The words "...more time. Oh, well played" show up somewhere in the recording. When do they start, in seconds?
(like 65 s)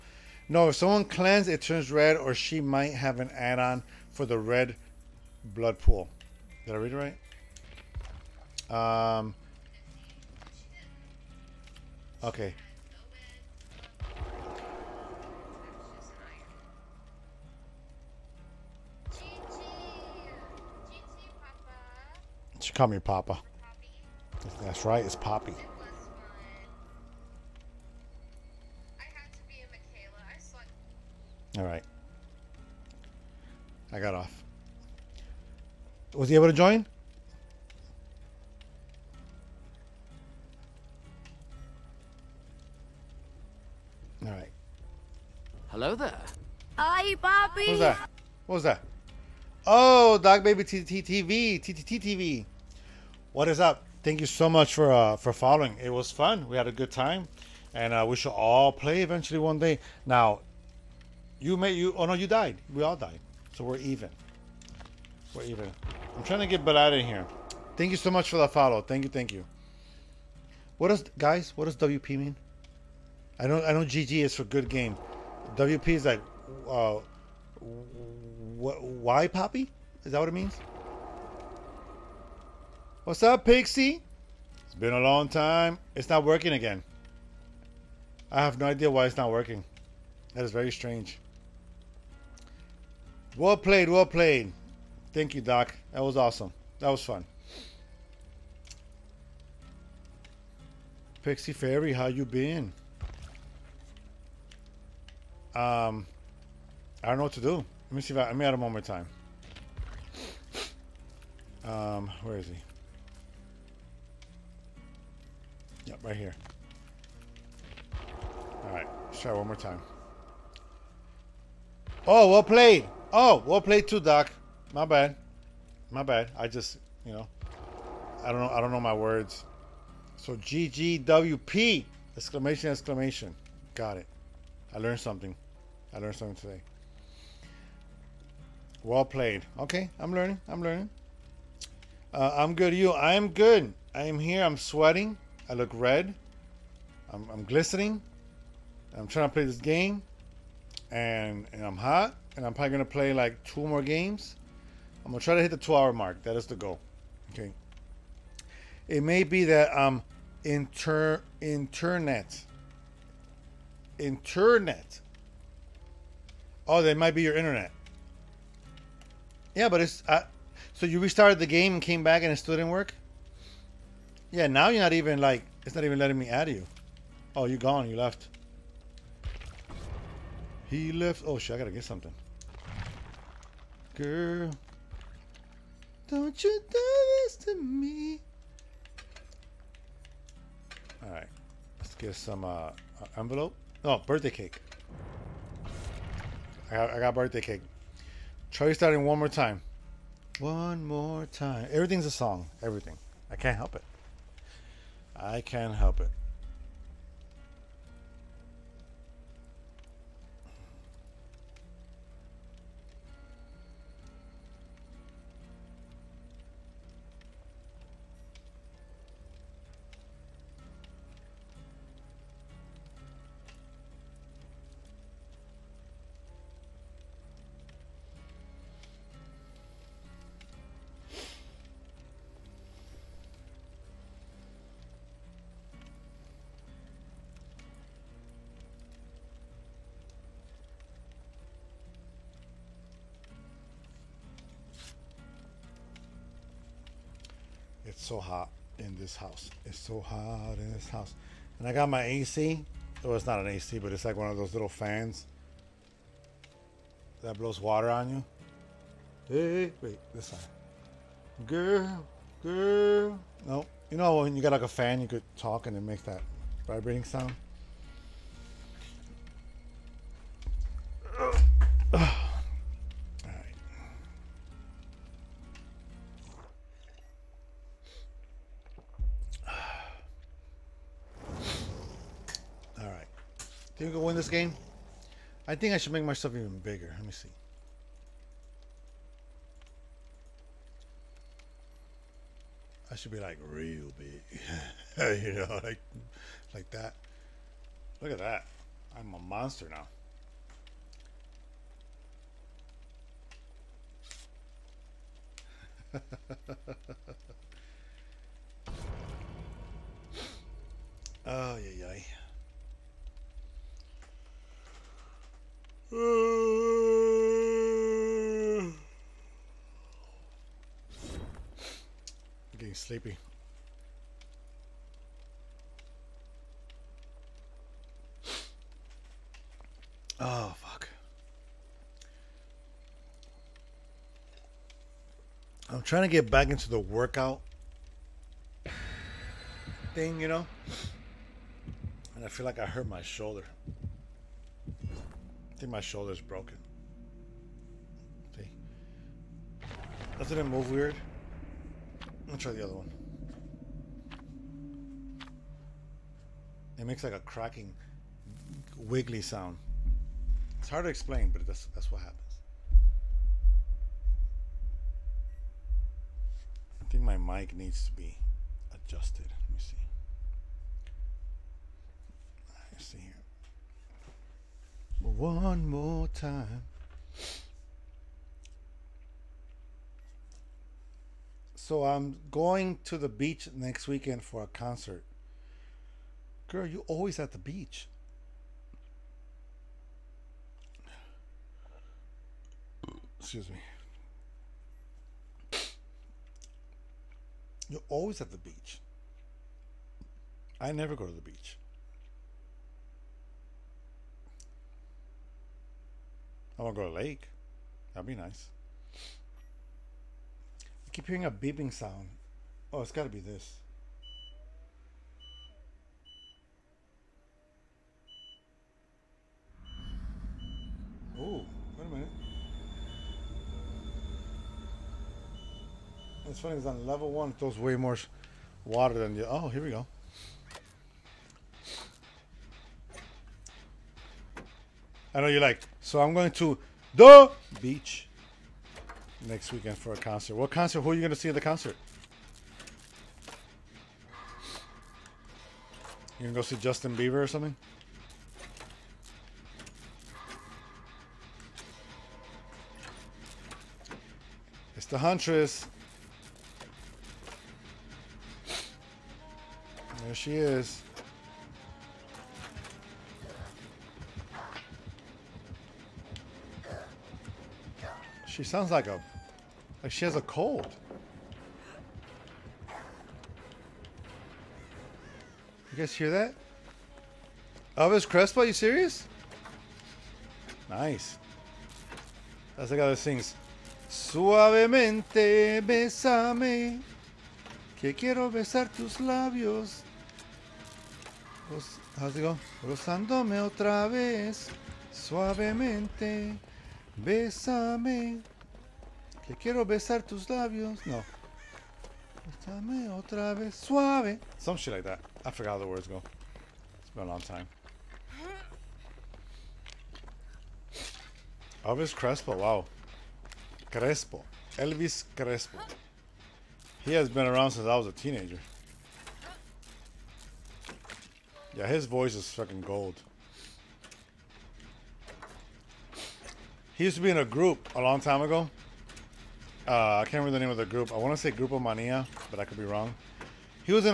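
119 s.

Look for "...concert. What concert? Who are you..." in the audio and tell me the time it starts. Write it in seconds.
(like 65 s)
439 s.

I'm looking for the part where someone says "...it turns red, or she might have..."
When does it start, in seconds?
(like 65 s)
1 s.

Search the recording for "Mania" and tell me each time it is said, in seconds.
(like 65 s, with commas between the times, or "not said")
531 s.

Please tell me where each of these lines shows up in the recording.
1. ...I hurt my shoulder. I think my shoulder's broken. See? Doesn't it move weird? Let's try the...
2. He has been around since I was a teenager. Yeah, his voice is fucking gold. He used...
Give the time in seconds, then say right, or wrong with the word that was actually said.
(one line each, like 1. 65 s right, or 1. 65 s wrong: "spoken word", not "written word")
1. 342 s right
2. 516 s right.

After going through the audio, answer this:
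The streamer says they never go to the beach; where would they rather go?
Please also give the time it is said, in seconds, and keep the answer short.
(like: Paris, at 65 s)
a lake, at 406 s.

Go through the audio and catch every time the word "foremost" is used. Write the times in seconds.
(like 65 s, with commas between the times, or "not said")
not said.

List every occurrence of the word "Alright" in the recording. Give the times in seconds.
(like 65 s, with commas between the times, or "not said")
31 s, 44 s.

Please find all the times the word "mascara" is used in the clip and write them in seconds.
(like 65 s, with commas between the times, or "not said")
not said.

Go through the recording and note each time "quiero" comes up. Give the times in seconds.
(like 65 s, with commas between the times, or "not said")
487 s, 499 s.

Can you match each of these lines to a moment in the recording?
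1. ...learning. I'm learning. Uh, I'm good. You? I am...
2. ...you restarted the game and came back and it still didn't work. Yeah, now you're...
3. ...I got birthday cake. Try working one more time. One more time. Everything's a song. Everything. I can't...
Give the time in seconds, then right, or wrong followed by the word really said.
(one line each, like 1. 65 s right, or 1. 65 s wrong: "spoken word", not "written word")
1. 140 s right
2. 170 s right
3. 196 s wrong: "starting", not "working".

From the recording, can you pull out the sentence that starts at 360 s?
It's hard to explain, but that's, that's what happens.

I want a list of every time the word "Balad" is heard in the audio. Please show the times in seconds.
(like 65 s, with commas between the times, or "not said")
66 s.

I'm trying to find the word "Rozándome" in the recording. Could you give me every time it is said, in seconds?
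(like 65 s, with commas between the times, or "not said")
492 s.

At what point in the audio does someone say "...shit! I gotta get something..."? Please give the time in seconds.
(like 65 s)
181 s.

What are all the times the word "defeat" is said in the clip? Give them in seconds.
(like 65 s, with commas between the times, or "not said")
not said.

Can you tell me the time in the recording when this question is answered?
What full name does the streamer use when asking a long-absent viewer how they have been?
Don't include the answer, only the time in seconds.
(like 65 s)
101 s.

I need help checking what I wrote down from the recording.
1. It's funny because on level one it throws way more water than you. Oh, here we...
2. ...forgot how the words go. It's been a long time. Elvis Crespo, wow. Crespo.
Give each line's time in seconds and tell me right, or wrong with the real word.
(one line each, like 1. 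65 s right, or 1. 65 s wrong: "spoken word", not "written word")
1. 426 s right
2. 505 s right.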